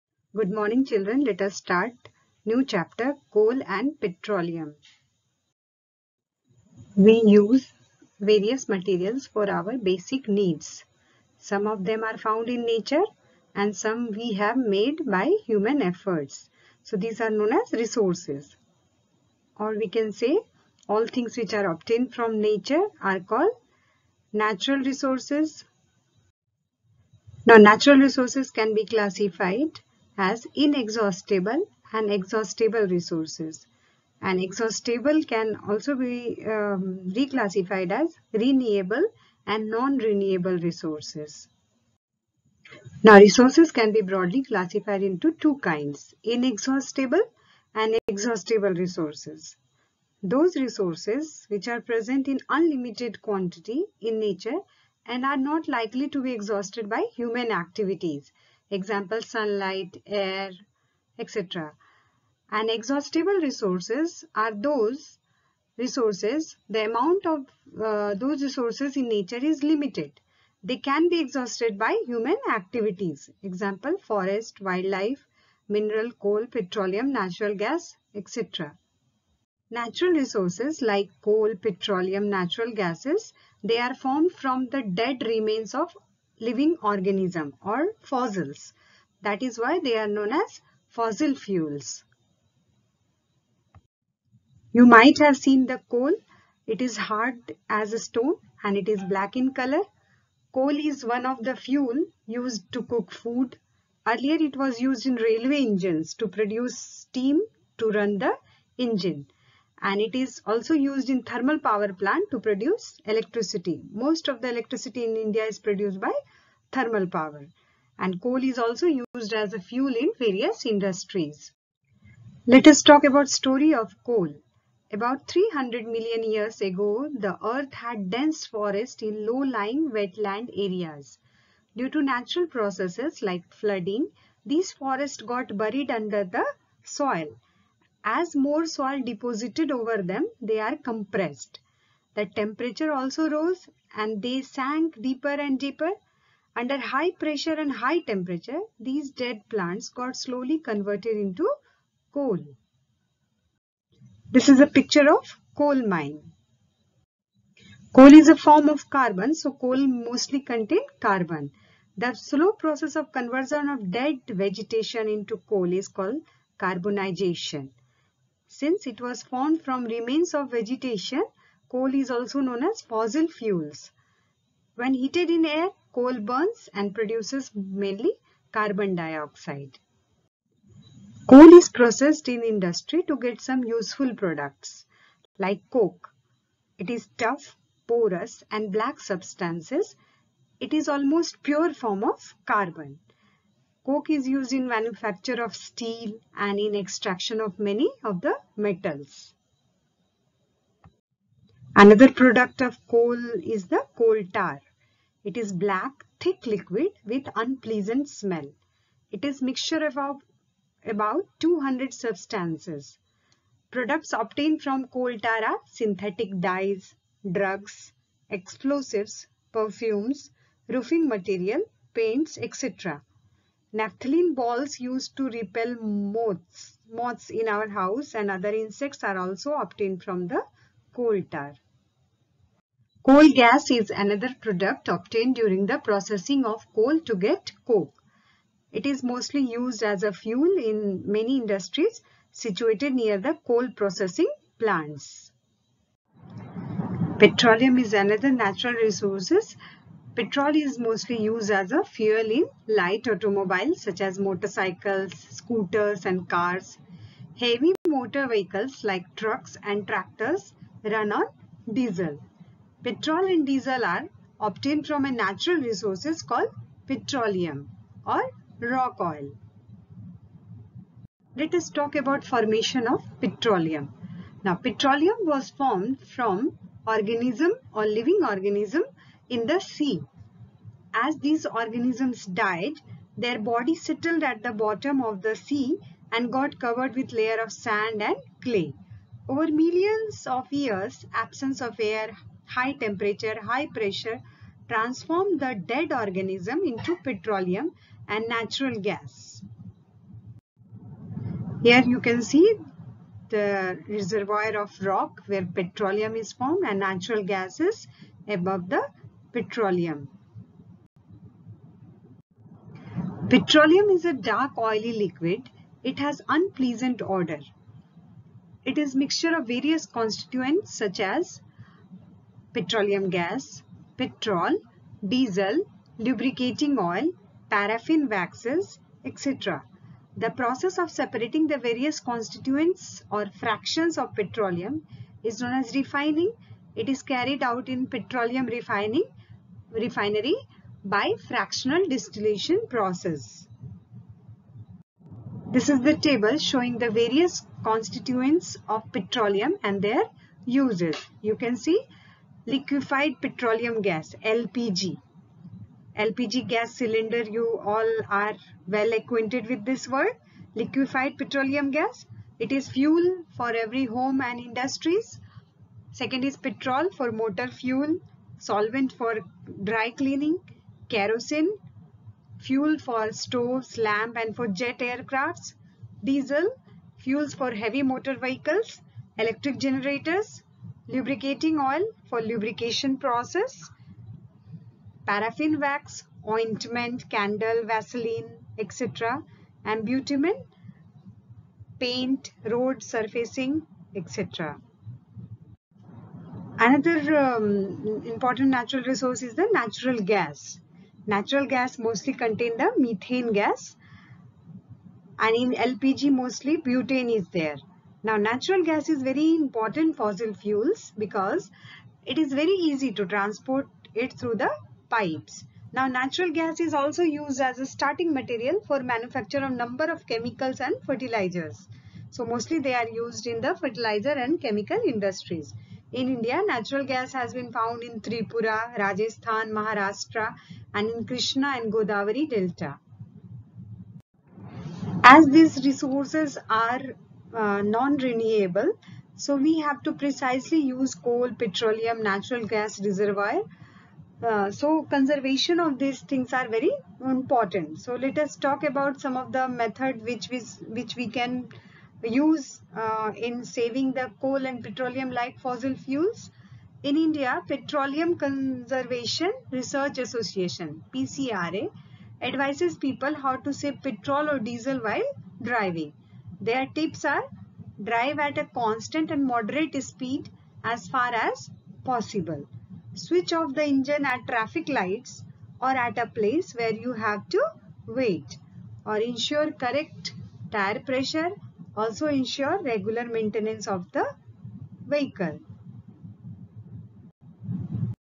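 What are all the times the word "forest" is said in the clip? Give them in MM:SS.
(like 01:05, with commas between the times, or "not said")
01:13, 02:08, 02:14.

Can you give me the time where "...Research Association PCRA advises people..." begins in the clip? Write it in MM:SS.
07:39.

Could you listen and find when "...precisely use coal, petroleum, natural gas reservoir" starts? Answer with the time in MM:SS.
07:19.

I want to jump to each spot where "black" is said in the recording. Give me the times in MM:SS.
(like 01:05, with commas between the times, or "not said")
01:39, 03:08, 03:25.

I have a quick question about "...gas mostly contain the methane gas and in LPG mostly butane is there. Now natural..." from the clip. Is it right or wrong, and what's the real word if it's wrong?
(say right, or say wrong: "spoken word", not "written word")
right.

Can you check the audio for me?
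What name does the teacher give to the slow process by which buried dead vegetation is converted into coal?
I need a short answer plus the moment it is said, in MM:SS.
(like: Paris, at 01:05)
carbonization, at 02:46.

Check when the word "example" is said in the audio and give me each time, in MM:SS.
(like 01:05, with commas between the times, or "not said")
00:58, 01:13.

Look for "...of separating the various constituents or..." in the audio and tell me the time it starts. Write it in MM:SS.
05:30.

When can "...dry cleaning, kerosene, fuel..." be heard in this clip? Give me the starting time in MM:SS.
06:09.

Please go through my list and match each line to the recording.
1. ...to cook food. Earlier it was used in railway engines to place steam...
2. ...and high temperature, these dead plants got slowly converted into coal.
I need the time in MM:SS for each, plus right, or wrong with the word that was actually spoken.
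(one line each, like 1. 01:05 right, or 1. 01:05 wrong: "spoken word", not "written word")
1. 01:42 wrong: "produce", not "place"
2. 02:27 right.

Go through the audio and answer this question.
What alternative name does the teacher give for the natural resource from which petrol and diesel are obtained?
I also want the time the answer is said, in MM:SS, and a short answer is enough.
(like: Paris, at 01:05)
rock oil, at 04:28.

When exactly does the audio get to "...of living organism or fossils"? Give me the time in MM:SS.
01:25.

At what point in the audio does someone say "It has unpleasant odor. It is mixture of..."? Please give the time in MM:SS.
05:15.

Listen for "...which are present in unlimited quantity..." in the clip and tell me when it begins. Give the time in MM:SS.
00:51.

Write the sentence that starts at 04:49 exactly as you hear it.
Over millions of years, absence of air, high temperature, high pressure transformed the dead organism into petroleum and natural gas.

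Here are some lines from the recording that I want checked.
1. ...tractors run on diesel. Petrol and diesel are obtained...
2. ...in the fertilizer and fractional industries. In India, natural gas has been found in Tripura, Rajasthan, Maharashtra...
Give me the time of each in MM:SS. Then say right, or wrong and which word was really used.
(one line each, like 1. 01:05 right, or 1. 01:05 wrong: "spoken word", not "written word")
1. 04:19 right
2. 07:03 wrong: "chemical", not "fractional".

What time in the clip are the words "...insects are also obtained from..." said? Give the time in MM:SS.
03:48.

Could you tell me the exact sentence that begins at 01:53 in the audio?
Most of the electricity in India is produced by thermal power and coal is also used as a fuel in various industries.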